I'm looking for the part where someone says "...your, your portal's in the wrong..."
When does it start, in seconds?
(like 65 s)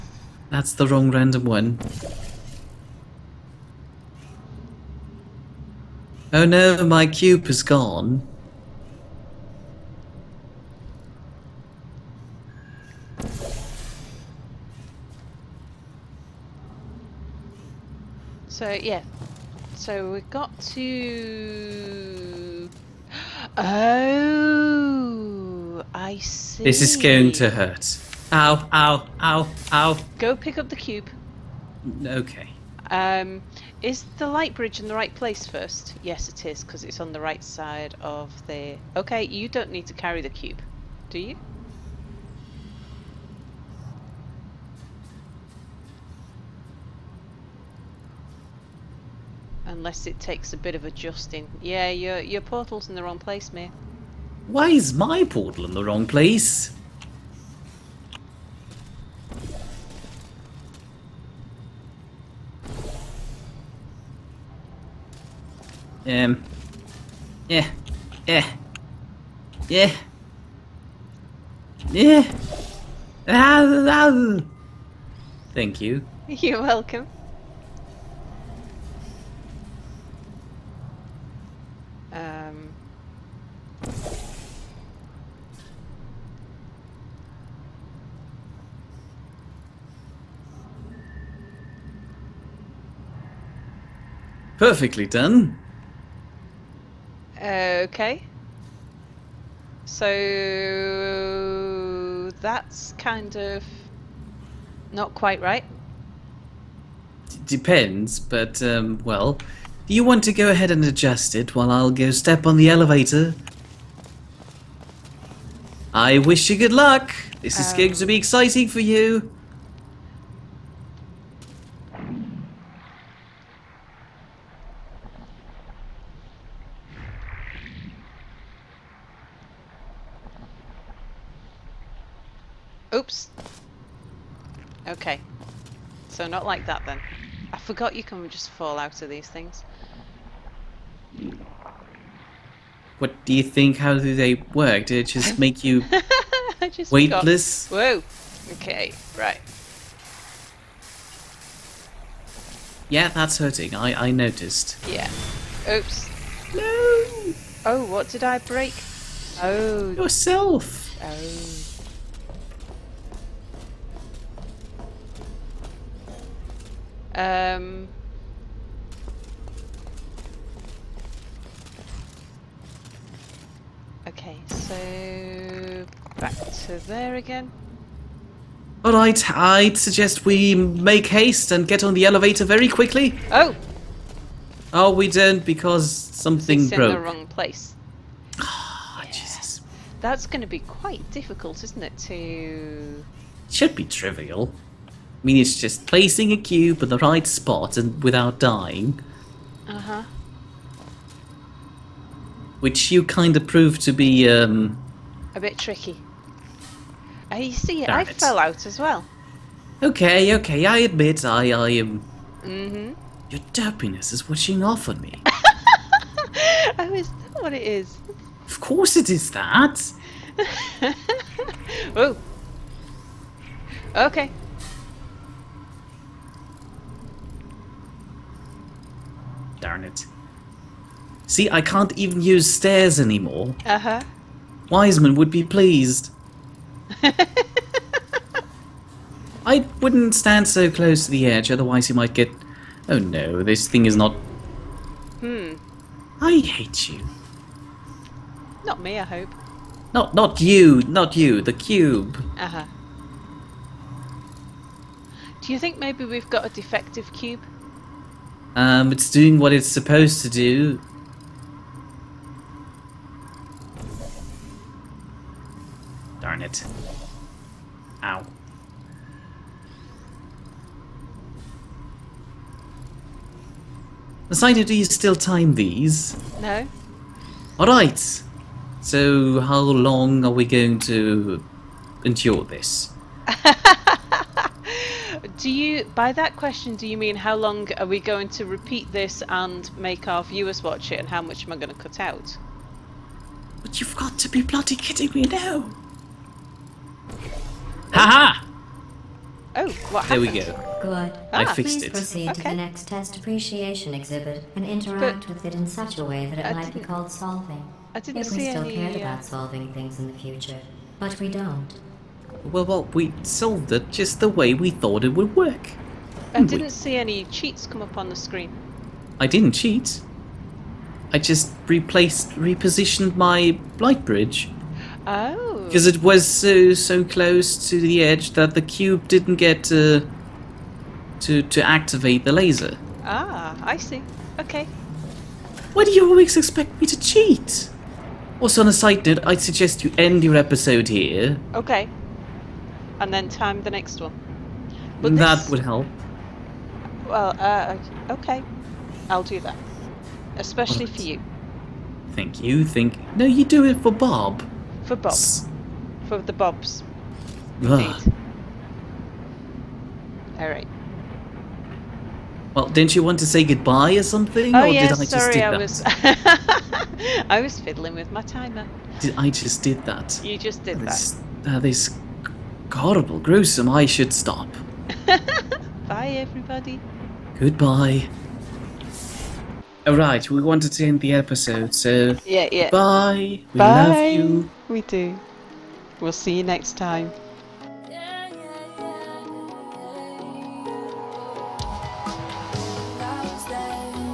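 51 s.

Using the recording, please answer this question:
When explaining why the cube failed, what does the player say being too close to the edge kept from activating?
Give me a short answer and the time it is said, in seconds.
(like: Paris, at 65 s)
the laser, at 332 s.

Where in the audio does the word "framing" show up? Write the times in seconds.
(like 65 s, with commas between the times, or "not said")
not said.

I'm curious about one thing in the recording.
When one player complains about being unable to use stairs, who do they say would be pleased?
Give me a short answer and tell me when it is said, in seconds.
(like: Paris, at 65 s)
Wiseman, at 234 s.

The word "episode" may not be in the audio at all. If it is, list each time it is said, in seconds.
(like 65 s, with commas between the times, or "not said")
340 s, 381 s.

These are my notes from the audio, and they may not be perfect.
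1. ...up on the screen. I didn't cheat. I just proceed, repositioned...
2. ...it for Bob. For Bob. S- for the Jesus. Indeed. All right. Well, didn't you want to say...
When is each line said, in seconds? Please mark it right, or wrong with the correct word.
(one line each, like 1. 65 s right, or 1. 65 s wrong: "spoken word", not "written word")
1. 317 s wrong: "replaced", not "proceed"
2. 353 s wrong: "Bobs", not "Jesus".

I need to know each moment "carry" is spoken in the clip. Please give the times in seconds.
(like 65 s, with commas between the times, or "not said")
39 s.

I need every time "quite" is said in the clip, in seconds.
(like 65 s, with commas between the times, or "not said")
105 s, 190 s.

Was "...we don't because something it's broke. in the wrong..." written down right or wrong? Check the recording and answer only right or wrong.
right.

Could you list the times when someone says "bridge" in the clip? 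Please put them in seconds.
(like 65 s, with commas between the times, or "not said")
34 s, 324 s.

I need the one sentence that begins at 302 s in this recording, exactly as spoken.
to the next test appreciation exhibit and interact but with it in such a way that it I might be called solving.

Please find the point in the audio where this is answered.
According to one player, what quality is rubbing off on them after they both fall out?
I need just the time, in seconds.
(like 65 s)
213 s.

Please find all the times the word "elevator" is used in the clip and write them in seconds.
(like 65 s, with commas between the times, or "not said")
112 s, 182 s.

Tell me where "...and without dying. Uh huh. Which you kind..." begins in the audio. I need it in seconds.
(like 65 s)
197 s.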